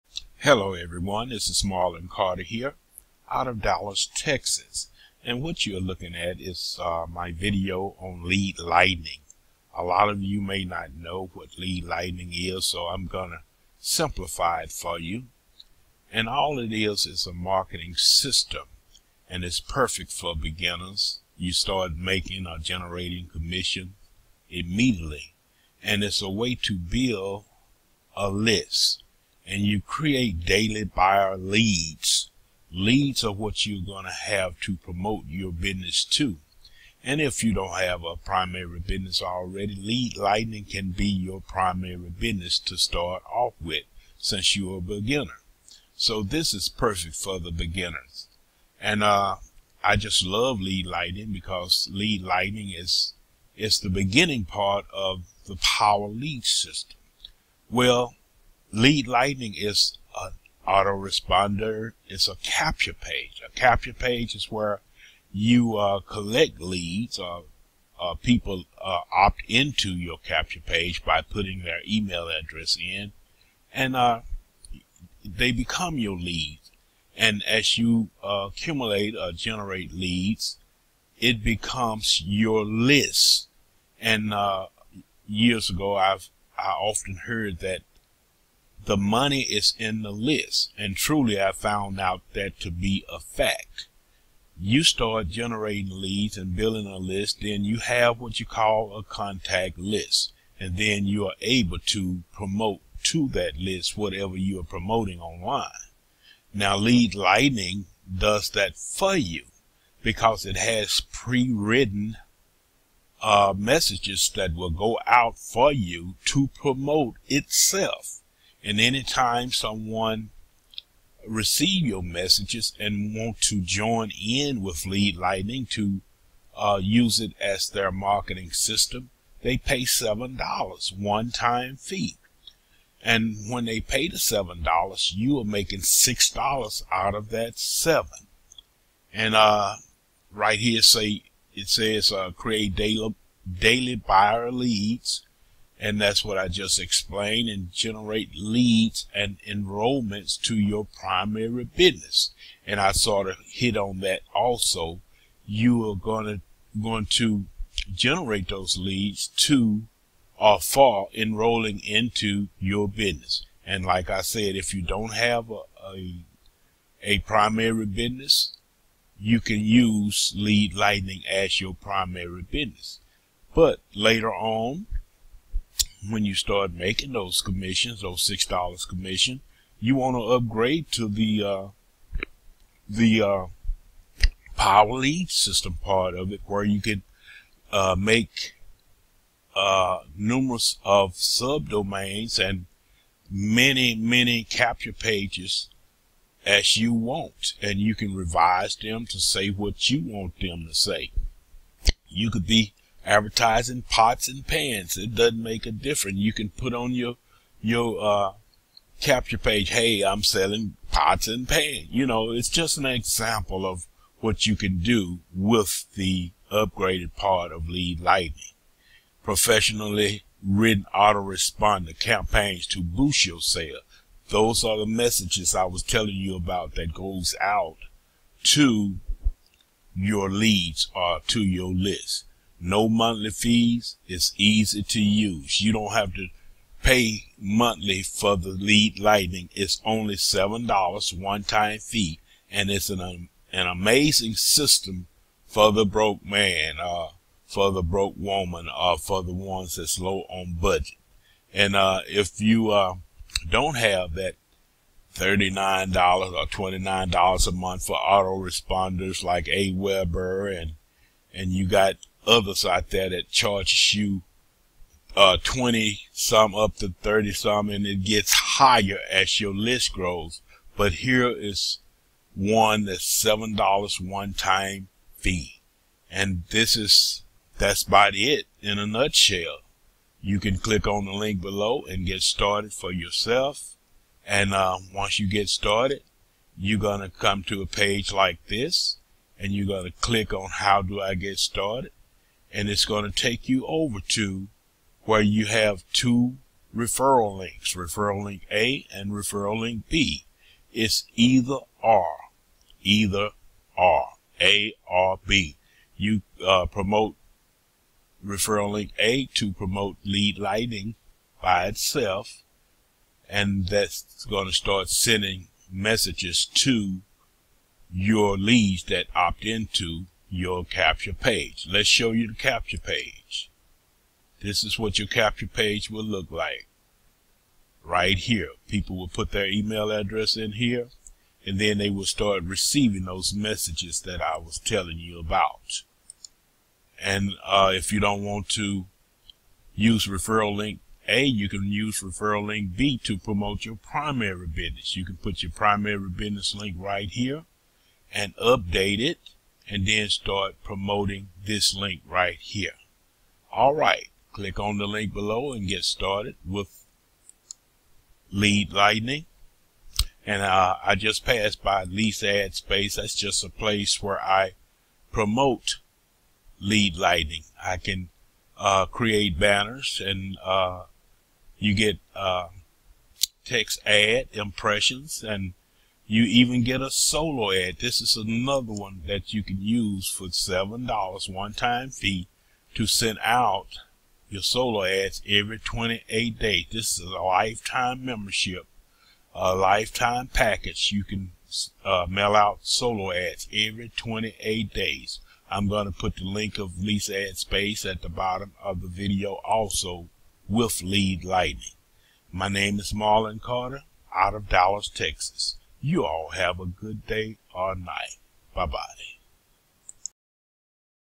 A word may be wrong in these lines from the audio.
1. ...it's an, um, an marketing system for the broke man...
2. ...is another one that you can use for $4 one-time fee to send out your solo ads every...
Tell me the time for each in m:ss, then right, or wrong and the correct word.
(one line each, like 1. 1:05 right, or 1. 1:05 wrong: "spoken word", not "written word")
1. 4:02 wrong: "amazing", not "marketing"
2. 6:18 wrong: "7", not "4".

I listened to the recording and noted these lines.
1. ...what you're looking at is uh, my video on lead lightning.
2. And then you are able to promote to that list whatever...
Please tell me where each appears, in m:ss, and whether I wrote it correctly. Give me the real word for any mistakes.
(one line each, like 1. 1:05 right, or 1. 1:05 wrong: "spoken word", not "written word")
1. 0:05 right
2. 1:40 right.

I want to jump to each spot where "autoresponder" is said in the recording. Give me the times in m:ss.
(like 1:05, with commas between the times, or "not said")
1:00, 3:40, 4:17.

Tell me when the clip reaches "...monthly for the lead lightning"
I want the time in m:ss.
3:57.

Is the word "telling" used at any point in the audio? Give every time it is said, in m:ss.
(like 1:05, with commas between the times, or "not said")
3:45, 5:34.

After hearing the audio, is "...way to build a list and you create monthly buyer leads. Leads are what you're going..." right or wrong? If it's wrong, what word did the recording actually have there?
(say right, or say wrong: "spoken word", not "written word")
wrong: "daily", not "monthly".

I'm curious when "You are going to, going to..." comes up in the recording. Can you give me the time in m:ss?
2:35.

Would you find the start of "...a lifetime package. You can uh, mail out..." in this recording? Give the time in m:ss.
6:29.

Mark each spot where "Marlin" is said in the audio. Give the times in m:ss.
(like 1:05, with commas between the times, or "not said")
0:01, 6:42.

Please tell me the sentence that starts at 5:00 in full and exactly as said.
It's either R, either R A or B.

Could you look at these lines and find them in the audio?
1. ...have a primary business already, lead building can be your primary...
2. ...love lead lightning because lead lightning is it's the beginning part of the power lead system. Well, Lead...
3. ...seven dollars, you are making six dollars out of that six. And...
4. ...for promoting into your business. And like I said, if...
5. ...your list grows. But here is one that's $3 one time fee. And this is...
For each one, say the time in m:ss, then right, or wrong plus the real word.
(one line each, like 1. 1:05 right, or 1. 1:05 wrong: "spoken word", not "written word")
1. 0:37 wrong: "lightning", not "building"
2. 0:50 right
3. 2:14 wrong: "seven", not "six"
4. 2:40 wrong: "enrolling", not "promoting"
5. 4:29 wrong: "7", not "3".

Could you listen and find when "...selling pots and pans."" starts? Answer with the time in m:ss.
3:30.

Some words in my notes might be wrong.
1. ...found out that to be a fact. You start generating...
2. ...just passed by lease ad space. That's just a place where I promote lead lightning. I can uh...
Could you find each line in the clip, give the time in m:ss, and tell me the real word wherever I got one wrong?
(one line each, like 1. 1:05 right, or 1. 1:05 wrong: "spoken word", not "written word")
1. 1:31 right
2. 6:00 right.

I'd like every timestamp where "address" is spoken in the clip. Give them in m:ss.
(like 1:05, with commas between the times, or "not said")
1:12, 5:29.